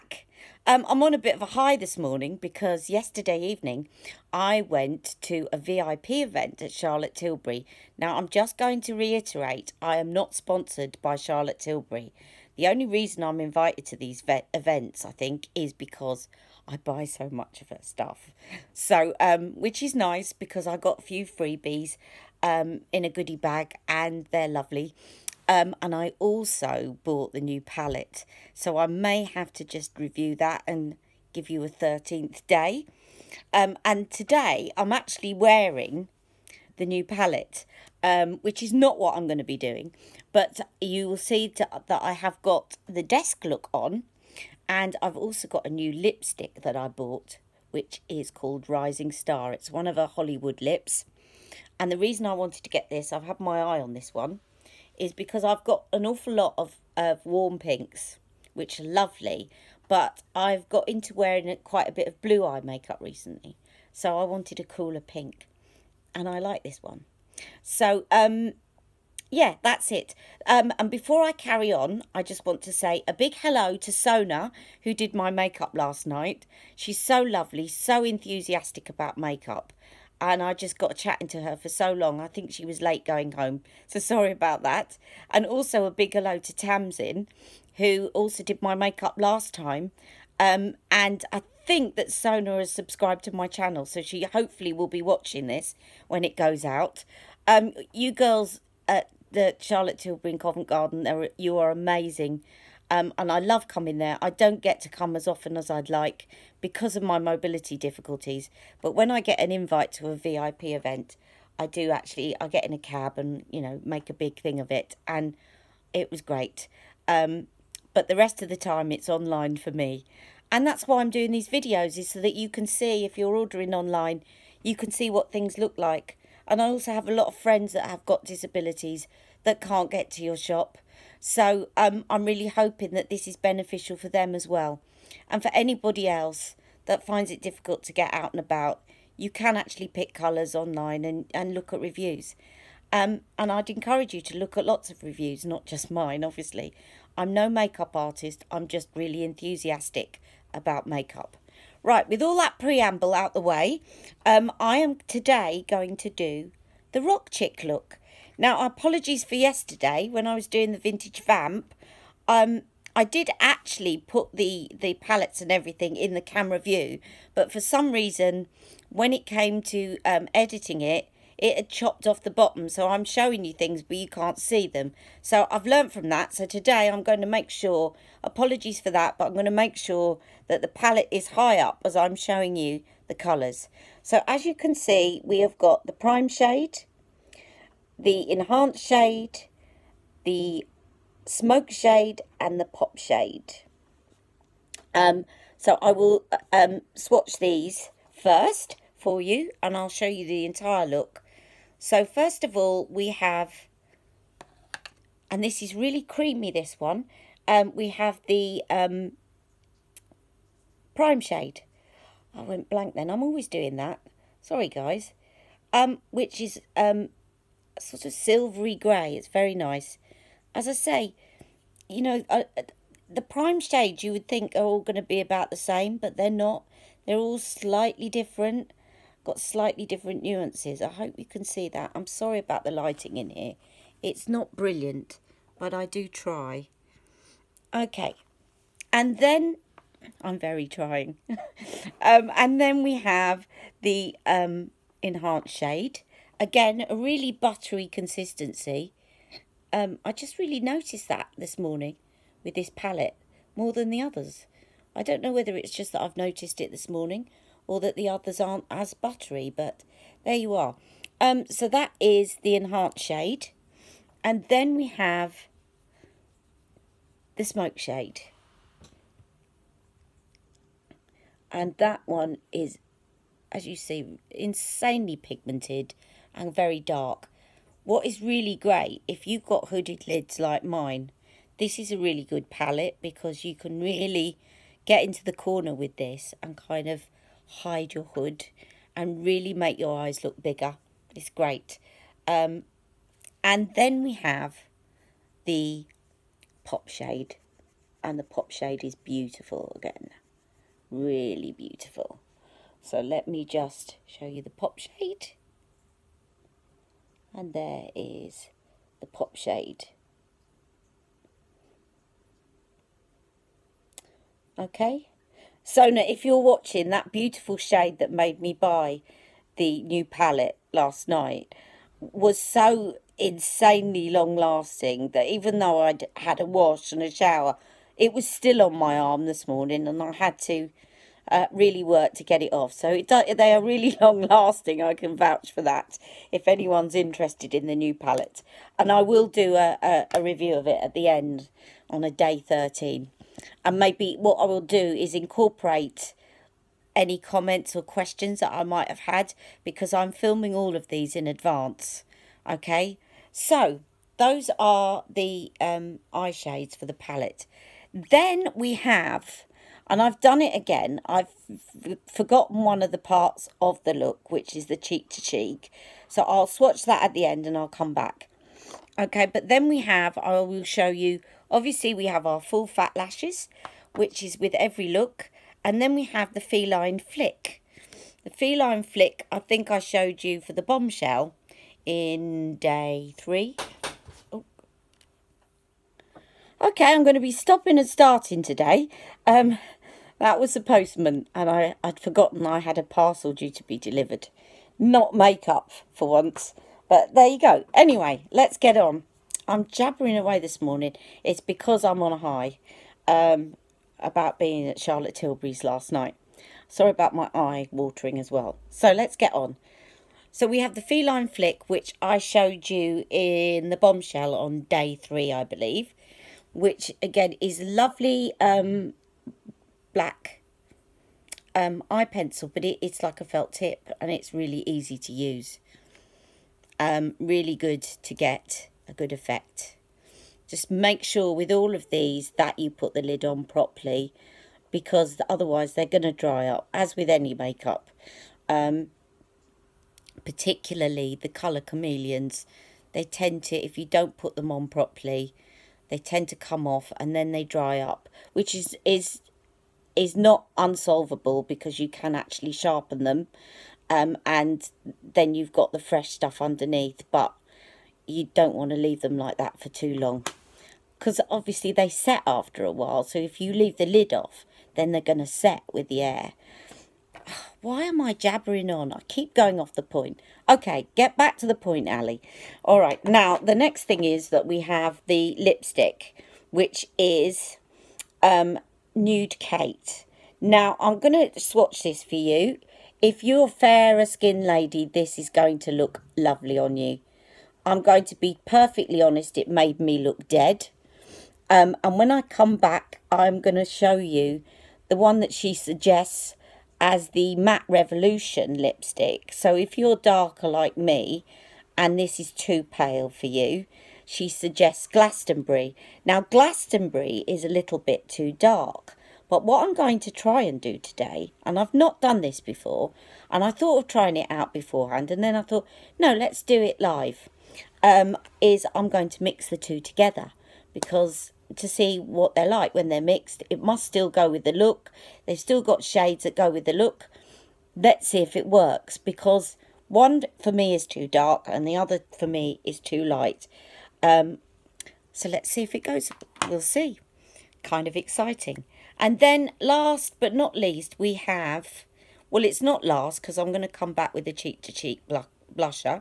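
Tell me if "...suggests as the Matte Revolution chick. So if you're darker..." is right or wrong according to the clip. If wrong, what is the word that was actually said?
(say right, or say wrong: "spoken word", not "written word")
wrong: "lipstick", not "chick".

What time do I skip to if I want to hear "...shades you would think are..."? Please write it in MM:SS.
03:43.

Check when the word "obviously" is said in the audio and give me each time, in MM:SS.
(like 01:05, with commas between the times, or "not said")
02:26, 06:11, 07:41.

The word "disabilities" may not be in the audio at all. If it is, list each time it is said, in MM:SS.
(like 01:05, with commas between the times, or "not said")
02:08.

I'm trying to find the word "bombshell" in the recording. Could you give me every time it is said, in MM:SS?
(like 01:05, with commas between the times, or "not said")
06:20, 06:53.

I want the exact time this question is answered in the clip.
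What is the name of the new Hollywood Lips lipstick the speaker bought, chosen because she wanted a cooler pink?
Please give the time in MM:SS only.
00:48.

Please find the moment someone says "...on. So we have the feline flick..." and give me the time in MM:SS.
06:49.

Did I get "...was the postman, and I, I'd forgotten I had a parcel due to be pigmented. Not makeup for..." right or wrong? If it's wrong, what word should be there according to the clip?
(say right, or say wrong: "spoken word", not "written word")
wrong: "delivered", not "pigmented".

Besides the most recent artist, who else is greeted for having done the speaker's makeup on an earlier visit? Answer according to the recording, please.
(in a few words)
Tamsin.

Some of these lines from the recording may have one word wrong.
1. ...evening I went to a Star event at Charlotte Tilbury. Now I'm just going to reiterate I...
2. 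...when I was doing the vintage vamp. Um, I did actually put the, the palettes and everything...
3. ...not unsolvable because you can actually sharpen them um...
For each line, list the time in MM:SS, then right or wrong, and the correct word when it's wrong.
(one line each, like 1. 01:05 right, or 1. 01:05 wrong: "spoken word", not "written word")
1. 00:03 wrong: "VIP", not "Star"
2. 02:40 right
3. 07:30 right.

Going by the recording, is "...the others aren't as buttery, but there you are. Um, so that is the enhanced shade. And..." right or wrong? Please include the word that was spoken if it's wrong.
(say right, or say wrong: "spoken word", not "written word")
right.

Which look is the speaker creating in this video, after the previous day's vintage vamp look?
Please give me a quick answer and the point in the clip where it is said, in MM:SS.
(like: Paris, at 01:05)
Rock chick, at 02:37.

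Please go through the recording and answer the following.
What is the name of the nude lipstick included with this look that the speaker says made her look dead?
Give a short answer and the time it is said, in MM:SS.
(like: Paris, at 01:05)
Nude Kate, at 07:59.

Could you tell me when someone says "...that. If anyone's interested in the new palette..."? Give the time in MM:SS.
05:35.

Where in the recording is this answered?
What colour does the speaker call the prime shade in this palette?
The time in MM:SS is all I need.
03:38.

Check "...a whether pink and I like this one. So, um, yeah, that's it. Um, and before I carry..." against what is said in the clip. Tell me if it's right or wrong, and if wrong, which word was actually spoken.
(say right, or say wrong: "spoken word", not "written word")
wrong: "cooler", not "whether".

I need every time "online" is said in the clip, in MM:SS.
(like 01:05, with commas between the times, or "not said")
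01:59, 02:03, 02:20.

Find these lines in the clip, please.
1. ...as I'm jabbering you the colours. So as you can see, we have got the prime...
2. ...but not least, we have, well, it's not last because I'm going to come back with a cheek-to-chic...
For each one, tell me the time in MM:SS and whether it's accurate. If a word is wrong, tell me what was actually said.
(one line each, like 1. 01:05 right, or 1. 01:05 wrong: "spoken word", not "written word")
1. 03:01 wrong: "showing", not "jabbering"
2. 09:00 right.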